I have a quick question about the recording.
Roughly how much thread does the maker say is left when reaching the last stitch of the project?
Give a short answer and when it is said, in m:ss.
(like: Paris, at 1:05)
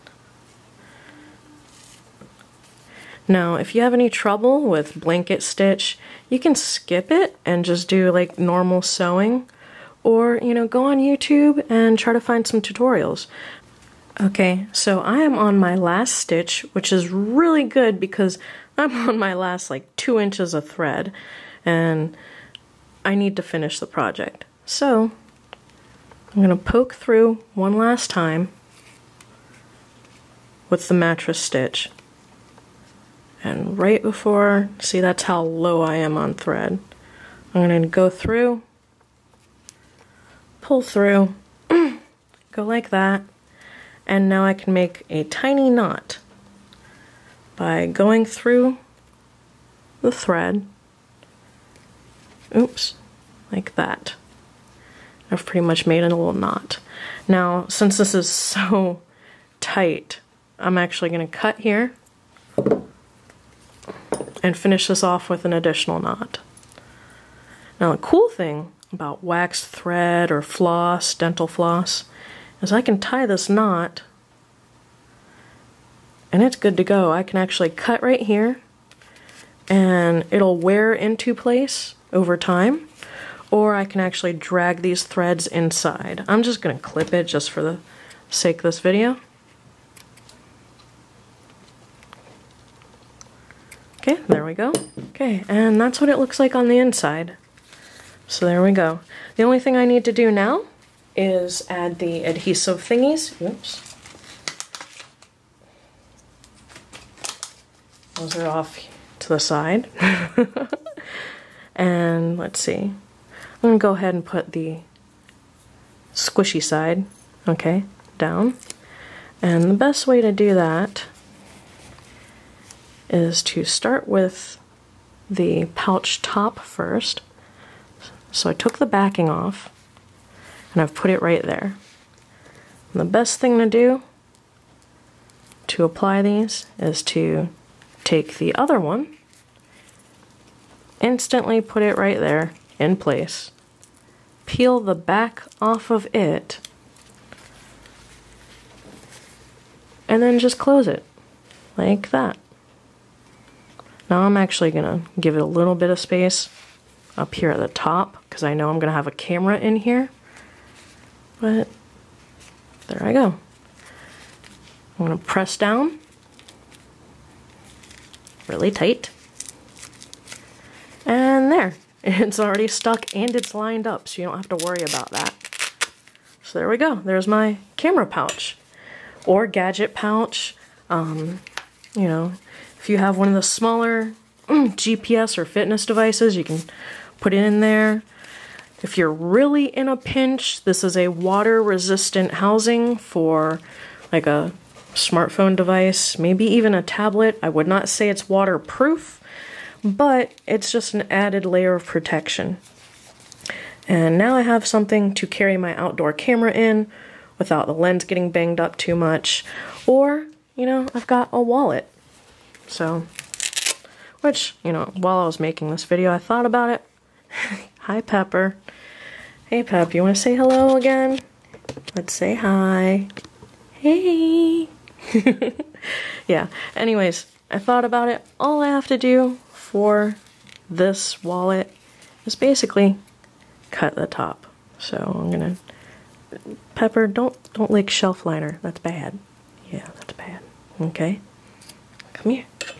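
2 inches, at 0:19.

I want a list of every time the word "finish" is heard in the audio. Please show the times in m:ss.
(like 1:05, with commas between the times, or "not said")
0:23, 1:04.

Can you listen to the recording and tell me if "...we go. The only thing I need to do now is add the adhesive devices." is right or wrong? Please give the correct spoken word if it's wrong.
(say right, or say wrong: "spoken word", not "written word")
wrong: "thingies", not "devices".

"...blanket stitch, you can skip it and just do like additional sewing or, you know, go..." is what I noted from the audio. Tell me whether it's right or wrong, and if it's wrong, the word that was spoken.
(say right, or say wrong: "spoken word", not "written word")
wrong: "normal", not "additional".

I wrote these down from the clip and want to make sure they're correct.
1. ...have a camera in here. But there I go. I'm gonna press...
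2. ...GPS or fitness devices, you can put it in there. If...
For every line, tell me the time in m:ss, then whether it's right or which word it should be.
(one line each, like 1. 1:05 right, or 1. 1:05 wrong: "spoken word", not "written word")
1. 2:38 right
2. 3:04 right.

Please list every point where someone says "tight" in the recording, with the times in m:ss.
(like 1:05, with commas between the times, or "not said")
0:59, 2:48.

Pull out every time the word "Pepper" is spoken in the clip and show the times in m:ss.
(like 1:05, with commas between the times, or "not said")
3:37, 3:56.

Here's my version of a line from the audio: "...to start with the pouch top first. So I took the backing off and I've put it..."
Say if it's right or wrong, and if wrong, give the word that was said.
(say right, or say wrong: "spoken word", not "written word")
right.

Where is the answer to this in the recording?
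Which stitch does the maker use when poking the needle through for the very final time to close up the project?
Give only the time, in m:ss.
0:30.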